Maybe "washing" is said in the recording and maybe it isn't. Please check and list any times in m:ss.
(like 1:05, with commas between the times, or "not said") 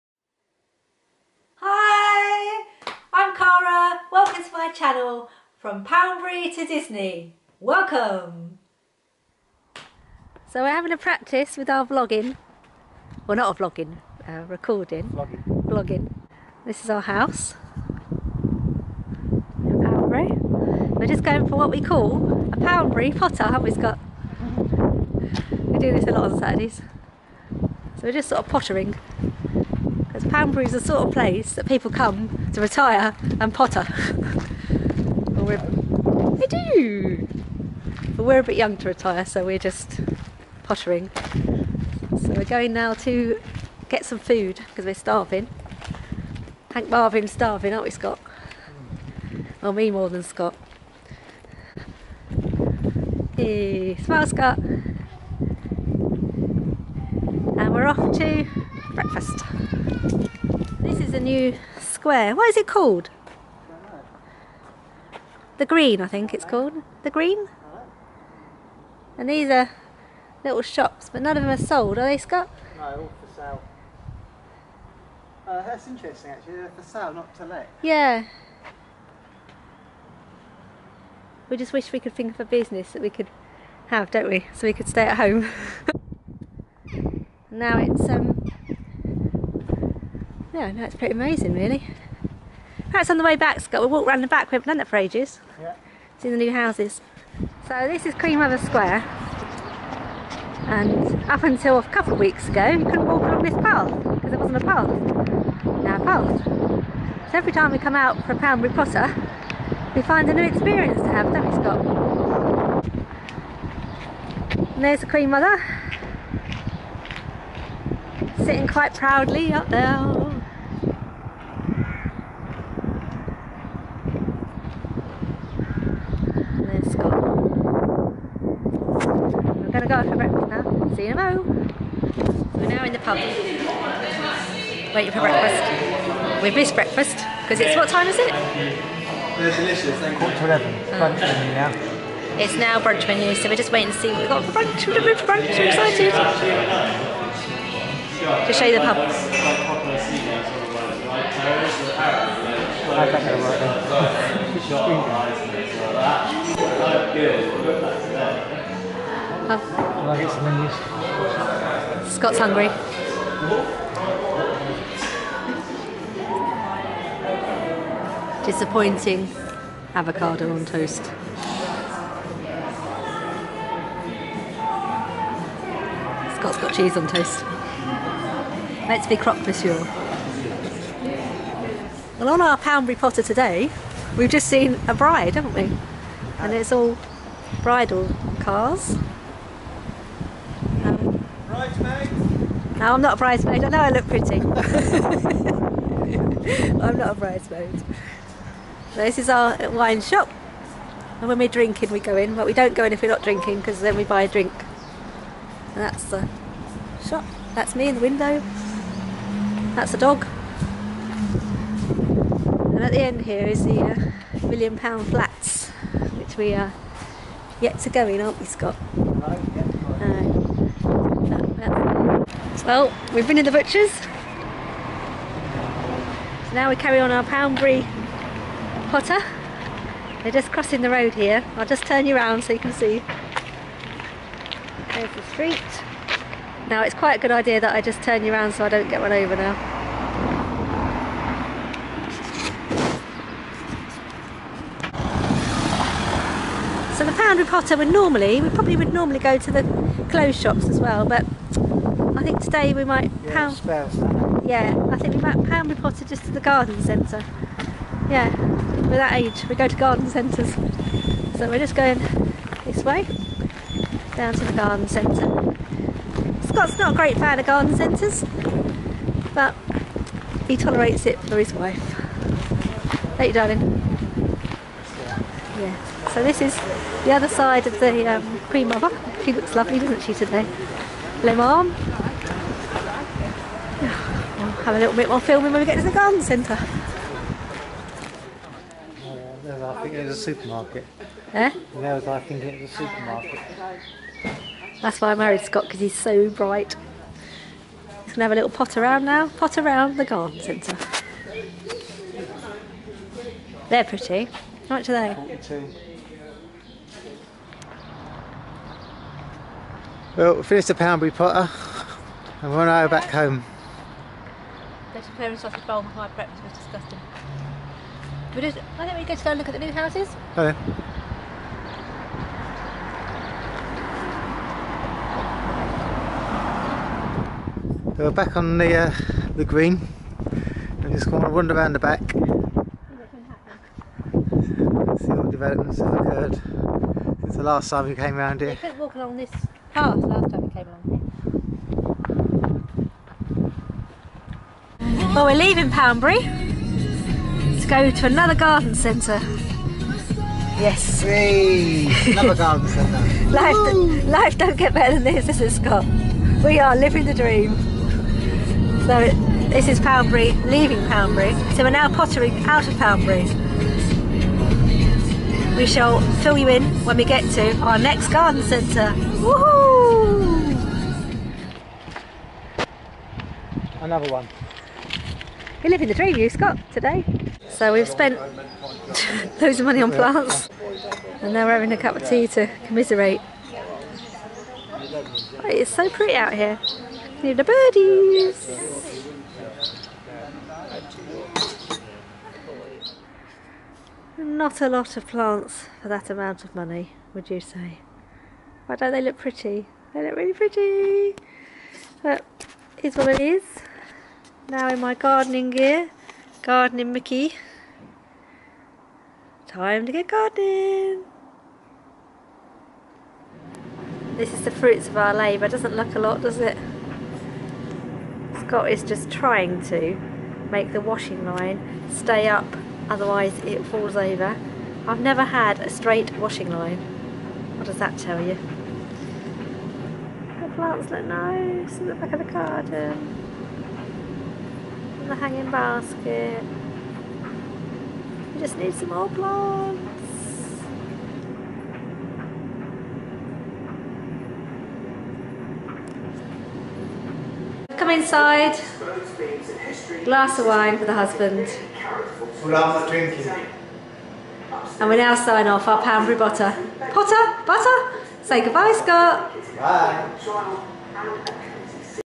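7:00, 7:06.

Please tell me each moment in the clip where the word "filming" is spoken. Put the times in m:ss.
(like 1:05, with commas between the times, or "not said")
4:45.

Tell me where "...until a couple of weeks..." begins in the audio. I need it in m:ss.
1:41.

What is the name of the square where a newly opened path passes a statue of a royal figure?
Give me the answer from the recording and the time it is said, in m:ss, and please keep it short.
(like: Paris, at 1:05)
Queen Mother Square, at 1:38.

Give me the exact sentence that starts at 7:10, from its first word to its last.
The plants look nice in the back of the garden.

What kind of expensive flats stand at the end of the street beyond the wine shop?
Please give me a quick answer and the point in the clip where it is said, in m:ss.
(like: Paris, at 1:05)
million pound flats, at 3:34.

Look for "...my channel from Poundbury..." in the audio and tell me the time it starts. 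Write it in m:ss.
0:04.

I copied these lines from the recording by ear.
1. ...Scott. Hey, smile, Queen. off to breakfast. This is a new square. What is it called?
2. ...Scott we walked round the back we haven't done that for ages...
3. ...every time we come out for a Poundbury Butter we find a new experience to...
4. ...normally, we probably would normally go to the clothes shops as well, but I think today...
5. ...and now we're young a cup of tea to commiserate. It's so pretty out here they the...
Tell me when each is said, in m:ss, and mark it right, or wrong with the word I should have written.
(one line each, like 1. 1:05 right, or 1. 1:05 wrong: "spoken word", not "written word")
1. 0:50 wrong: "Scott", not "Queen"
2. 1:33 right
3. 1:47 wrong: "Potter", not "Butter"
4. 4:07 right
5. 6:21 wrong: "having", not "young".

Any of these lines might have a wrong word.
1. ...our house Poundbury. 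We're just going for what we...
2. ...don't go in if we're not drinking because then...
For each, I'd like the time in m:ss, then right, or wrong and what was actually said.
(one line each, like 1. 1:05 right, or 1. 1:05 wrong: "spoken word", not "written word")
1. 0:16 right
2. 3:22 right.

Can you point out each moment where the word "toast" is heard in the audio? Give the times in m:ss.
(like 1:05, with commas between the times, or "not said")
2:50, 2:57.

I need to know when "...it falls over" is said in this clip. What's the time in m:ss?
7:03.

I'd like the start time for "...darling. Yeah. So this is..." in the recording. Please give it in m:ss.
4:33.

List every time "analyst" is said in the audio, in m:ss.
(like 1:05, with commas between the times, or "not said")
not said.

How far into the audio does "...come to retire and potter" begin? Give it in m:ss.
0:31.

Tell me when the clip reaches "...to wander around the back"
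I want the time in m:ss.
5:31.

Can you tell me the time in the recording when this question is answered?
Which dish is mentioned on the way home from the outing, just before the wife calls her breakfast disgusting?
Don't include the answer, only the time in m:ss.
5:14.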